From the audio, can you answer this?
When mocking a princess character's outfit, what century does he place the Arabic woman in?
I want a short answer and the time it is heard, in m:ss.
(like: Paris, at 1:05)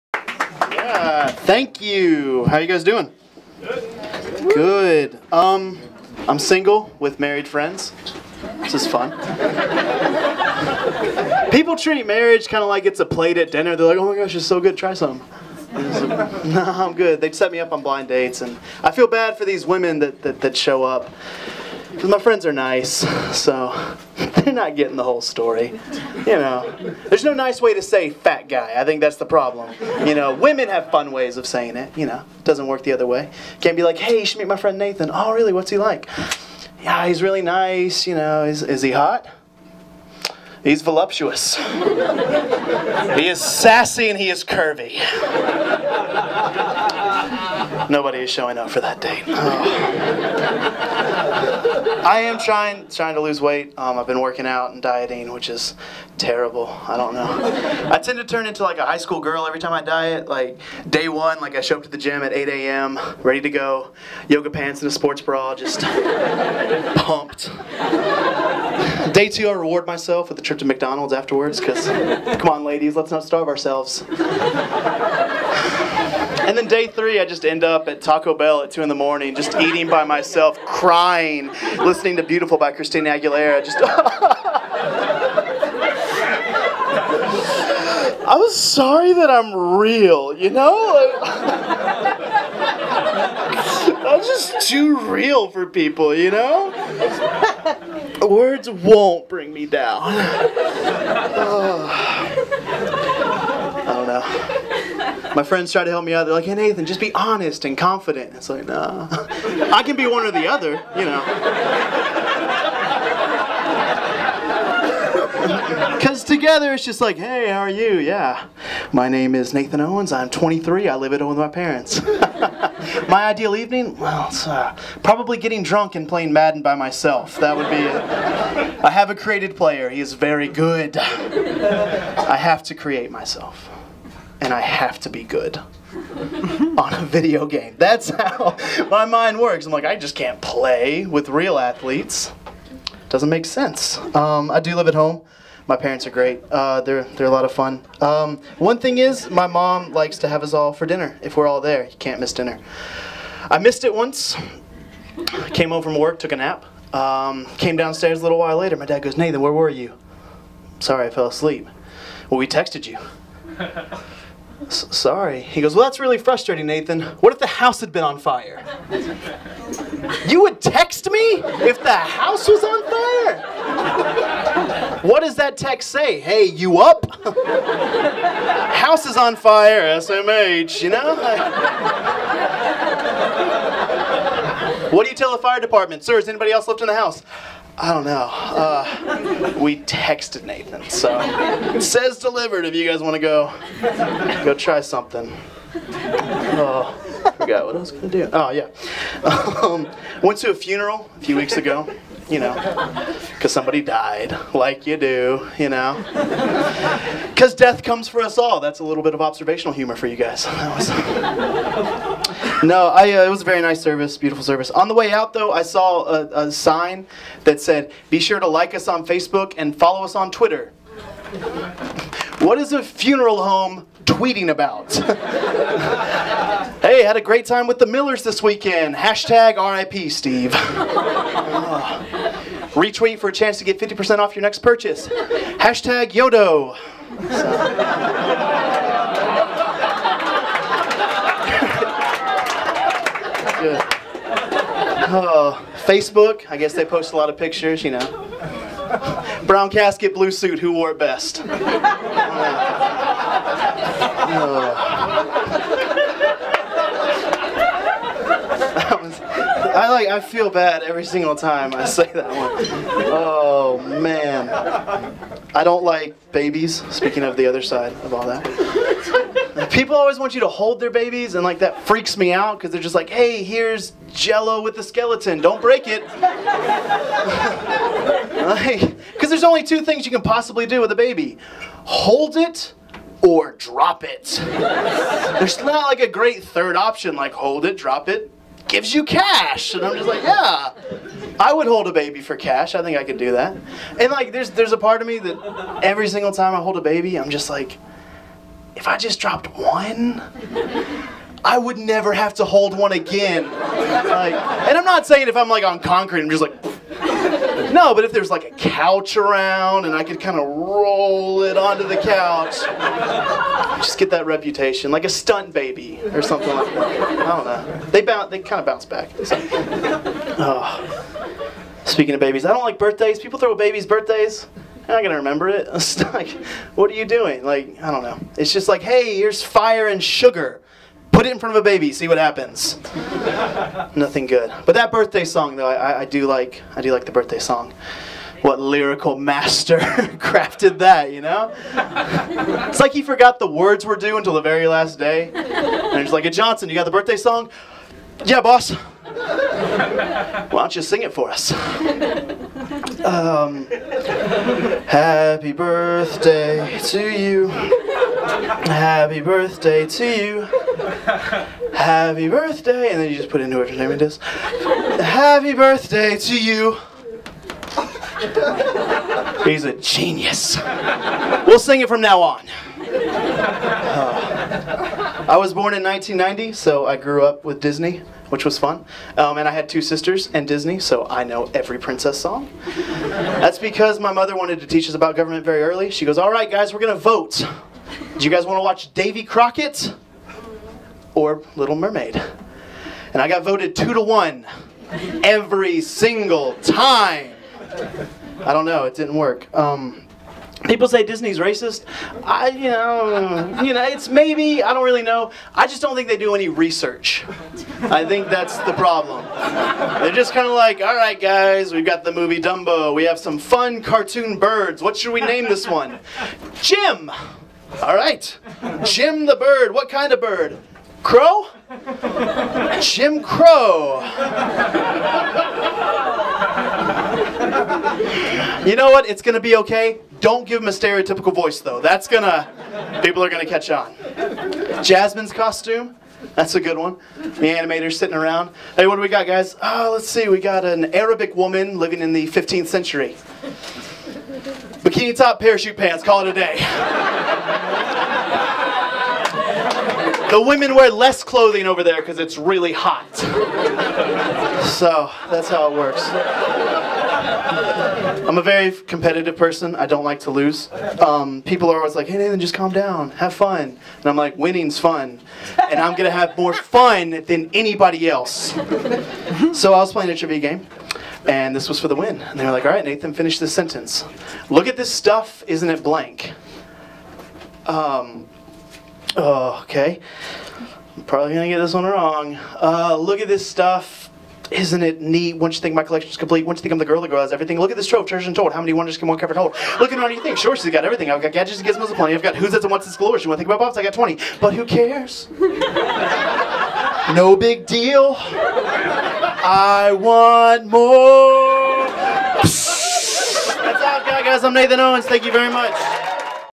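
15th century, at 7:22.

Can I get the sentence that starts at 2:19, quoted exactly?
I'm like, I just can't play with real athletes.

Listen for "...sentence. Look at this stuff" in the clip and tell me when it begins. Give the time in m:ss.
7:53.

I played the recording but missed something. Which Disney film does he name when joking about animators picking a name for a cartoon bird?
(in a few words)
Dumbo.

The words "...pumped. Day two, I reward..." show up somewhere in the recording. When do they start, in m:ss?
1:06.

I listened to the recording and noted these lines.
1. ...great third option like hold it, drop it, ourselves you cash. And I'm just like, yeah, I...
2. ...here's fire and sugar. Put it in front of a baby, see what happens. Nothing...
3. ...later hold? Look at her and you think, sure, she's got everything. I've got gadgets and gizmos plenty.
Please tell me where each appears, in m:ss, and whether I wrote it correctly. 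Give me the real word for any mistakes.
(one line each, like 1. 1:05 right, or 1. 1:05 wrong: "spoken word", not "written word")
1. 4:46 wrong: "gives", not "ourselves"
2. 5:29 right
3. 8:09 wrong: "cover", not "later".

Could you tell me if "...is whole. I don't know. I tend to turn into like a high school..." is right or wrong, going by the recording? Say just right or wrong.
wrong.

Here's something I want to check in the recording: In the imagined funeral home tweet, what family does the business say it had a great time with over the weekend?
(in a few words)
The Millers.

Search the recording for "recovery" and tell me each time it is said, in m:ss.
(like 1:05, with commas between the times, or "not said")
not said.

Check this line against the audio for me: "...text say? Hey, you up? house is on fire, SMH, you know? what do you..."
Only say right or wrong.
right.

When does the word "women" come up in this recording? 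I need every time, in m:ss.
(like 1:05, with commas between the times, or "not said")
0:19, 0:30, 7:30.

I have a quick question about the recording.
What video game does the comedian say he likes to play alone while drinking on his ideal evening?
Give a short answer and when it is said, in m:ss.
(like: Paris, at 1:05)
Madden, at 2:06.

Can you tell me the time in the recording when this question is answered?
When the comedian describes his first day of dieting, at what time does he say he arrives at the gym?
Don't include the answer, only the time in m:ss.
1:02.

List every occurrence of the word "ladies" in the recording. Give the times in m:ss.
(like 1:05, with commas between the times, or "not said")
1:12.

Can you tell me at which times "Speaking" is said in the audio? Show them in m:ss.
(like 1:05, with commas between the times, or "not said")
4:26, 5:21.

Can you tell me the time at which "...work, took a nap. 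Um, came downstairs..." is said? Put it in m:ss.
2:35.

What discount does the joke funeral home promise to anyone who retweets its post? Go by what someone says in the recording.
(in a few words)
50%.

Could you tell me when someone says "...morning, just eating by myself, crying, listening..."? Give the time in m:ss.
1:18.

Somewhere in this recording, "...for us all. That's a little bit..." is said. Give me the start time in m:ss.
3:28.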